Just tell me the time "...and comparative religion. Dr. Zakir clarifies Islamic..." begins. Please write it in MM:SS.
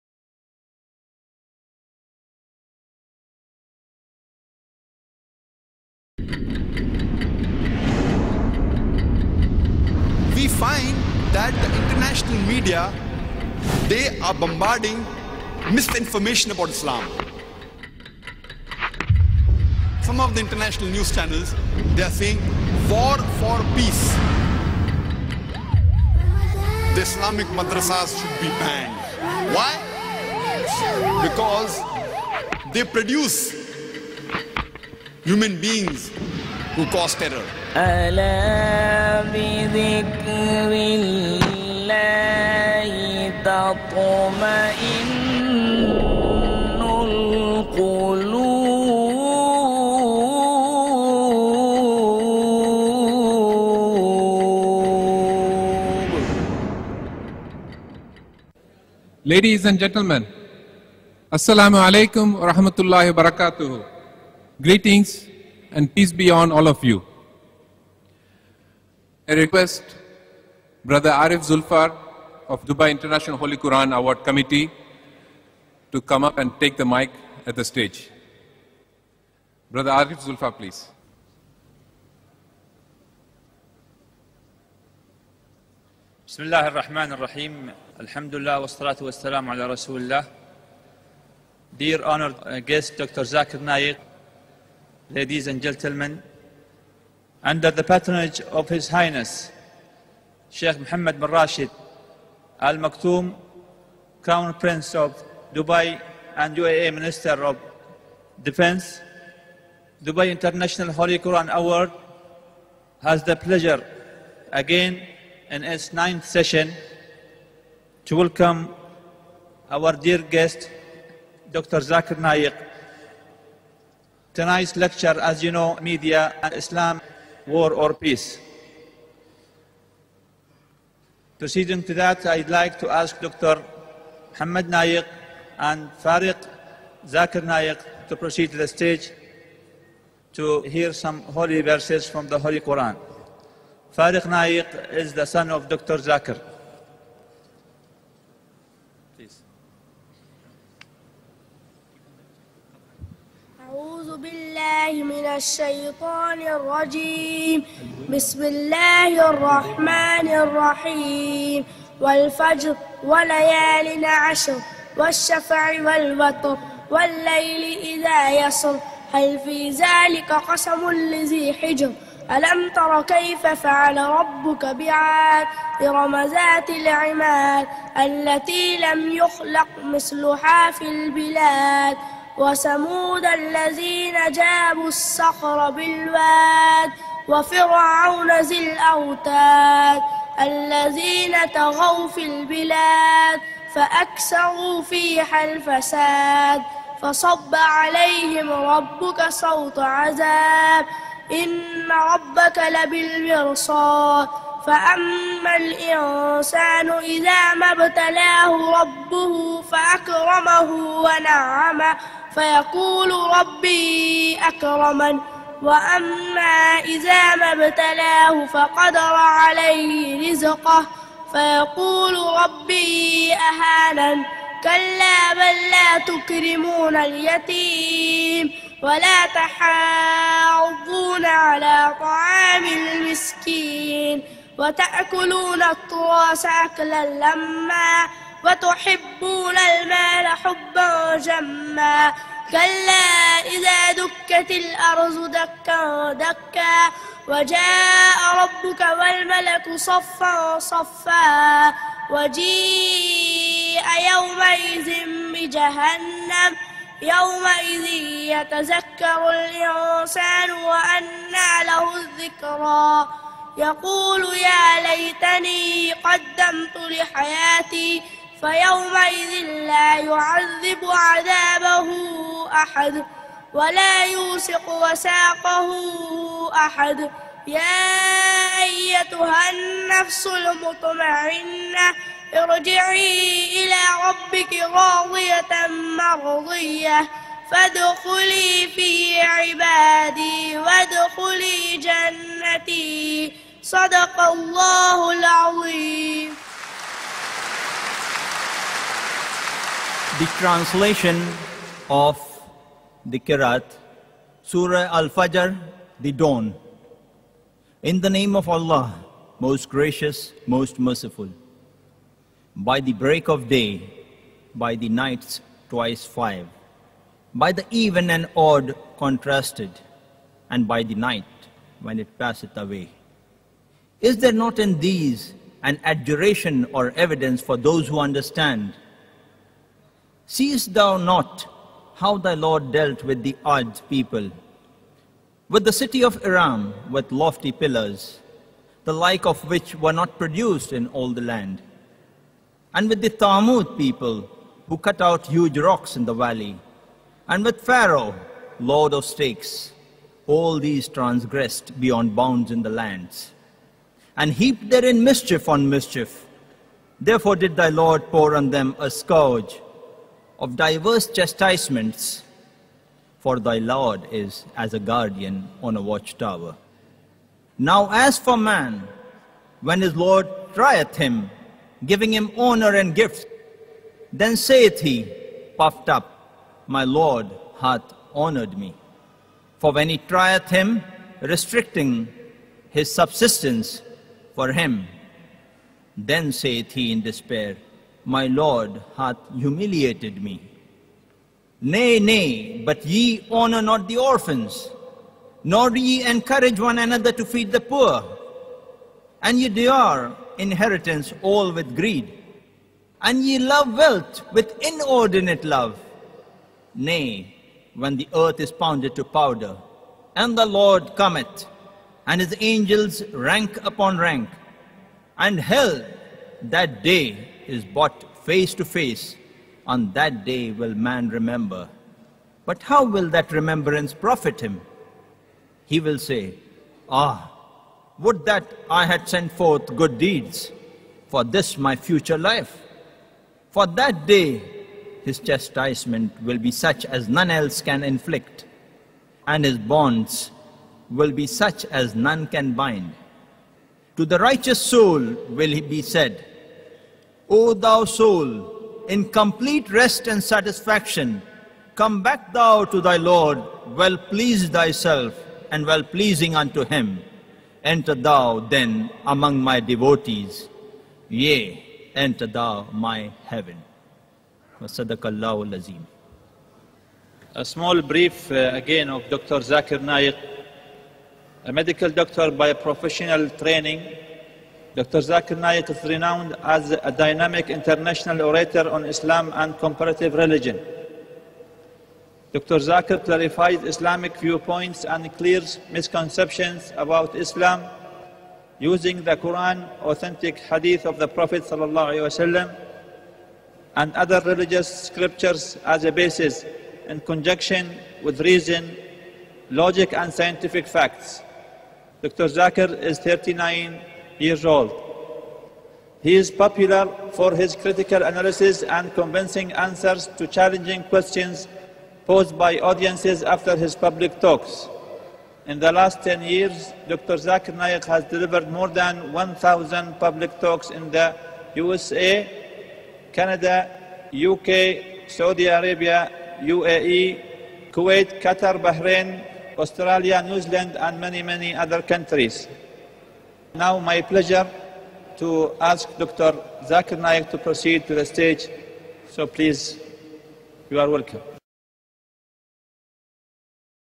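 07:59.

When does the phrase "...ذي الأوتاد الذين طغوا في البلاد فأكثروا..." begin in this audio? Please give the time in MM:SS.
03:08.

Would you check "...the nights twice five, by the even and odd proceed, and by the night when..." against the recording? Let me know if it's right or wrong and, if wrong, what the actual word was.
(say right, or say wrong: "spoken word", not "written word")
wrong: "contrasted", not "proceed".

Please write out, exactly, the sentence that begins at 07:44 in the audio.
A small brief uh, again of Dr.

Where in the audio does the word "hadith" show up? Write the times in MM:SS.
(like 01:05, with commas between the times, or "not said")
08:10.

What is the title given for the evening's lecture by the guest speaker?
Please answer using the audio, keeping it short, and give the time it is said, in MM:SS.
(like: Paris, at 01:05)
Media and Islam, War or Peace, at 02:05.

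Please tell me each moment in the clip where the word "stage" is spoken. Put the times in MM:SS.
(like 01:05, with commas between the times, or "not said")
01:17, 02:18, 08:58.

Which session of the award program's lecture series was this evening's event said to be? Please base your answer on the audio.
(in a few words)
Ninth.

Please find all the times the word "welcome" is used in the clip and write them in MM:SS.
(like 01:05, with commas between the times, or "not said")
01:58, 09:00.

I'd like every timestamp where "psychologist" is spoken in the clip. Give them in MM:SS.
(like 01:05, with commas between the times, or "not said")
not said.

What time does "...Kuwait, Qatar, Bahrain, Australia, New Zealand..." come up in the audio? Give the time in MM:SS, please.
08:47.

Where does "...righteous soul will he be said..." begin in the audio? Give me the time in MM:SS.
07:24.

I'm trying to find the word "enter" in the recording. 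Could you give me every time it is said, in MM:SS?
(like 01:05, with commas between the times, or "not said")
07:37, 07:41.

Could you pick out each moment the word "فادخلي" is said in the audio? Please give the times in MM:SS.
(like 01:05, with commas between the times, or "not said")
04:47.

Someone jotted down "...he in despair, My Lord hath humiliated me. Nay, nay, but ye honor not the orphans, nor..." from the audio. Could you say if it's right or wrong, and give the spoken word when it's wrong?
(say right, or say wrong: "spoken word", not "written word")
right.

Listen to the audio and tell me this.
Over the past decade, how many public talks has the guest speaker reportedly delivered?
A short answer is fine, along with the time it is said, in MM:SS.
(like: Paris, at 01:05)
More than 1,000, at 08:38.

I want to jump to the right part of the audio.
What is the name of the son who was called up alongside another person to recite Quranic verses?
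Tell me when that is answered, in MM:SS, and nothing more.
02:16.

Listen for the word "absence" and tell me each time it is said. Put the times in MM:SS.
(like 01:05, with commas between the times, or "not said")
not said.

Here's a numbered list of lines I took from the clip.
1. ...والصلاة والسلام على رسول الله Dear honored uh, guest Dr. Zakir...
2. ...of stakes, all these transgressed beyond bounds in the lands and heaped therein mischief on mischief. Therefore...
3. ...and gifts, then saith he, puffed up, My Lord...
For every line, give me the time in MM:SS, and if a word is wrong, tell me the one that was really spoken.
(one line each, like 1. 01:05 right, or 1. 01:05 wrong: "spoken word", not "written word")
1. 01:28 right
2. 05:48 right
3. 06:12 right.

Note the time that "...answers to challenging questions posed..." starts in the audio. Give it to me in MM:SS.
08:29.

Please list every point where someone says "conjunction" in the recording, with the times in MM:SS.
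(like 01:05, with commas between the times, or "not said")
08:17.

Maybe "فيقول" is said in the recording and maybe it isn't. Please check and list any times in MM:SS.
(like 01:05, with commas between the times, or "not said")
03:32, 03:41.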